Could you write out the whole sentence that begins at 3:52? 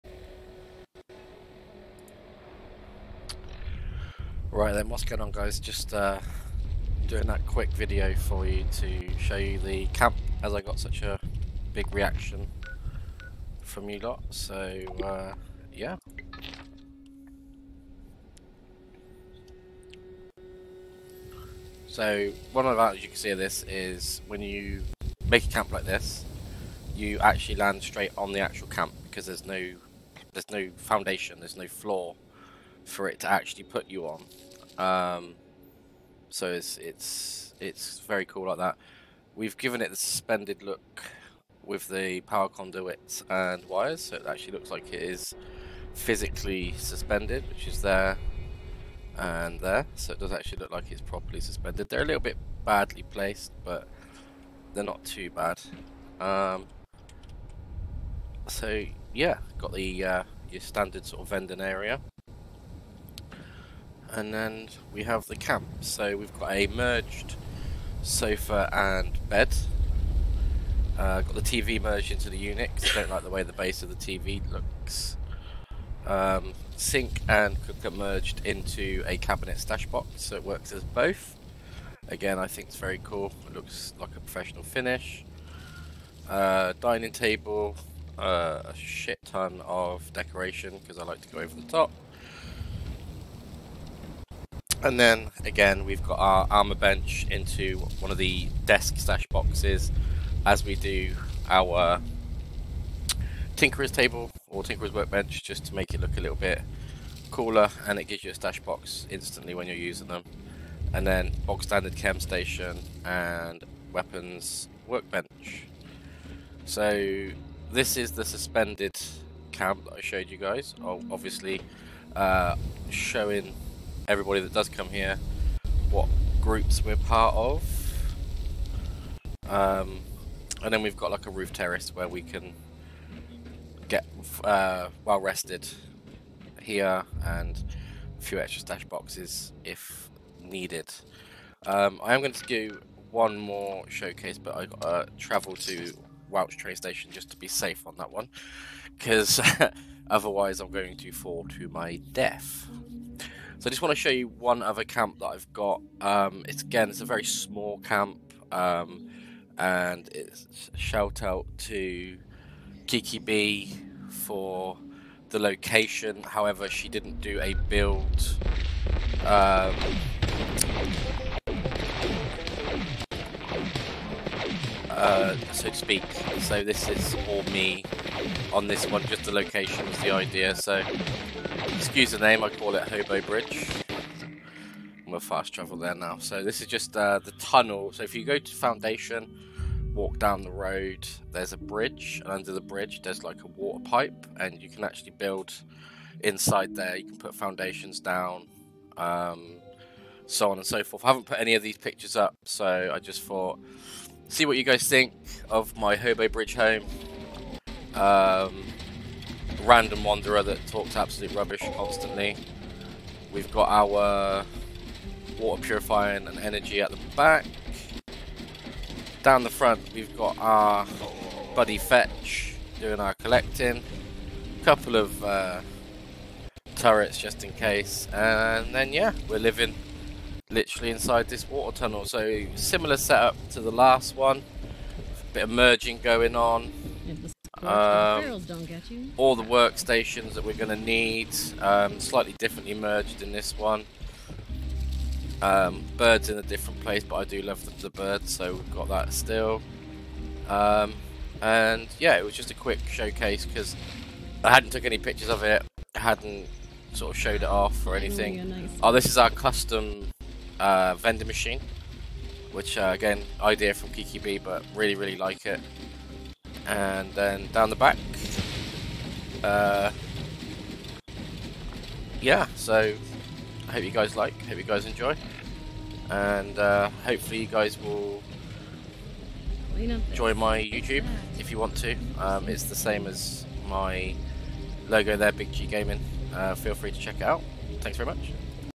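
So, similar setup to the last one.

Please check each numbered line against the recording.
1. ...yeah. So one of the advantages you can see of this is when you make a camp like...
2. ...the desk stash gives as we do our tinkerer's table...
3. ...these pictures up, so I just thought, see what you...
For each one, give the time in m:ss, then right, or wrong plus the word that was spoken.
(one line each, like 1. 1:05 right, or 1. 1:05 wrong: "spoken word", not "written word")
1. 0:15 right
2. 1:38 wrong: "boxes", not "gives"
3. 3:21 right.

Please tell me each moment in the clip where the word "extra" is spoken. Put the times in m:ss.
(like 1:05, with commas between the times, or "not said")
2:18.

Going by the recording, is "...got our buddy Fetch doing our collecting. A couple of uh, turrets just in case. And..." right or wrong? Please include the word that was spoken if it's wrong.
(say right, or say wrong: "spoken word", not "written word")
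right.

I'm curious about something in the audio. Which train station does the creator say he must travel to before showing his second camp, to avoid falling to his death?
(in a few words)
Welch train station.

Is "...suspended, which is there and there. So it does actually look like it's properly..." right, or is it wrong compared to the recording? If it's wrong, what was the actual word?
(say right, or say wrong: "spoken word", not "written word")
right.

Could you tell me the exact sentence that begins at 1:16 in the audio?
Um, sink and cooker merged into a cabinet stash box, so it works as both.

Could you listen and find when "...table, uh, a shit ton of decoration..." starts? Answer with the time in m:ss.
1:27.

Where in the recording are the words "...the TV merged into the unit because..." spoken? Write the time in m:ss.
1:11.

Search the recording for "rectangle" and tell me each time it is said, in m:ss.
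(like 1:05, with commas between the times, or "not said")
not said.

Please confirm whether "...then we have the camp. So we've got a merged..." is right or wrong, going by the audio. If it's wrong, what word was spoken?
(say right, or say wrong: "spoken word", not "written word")
right.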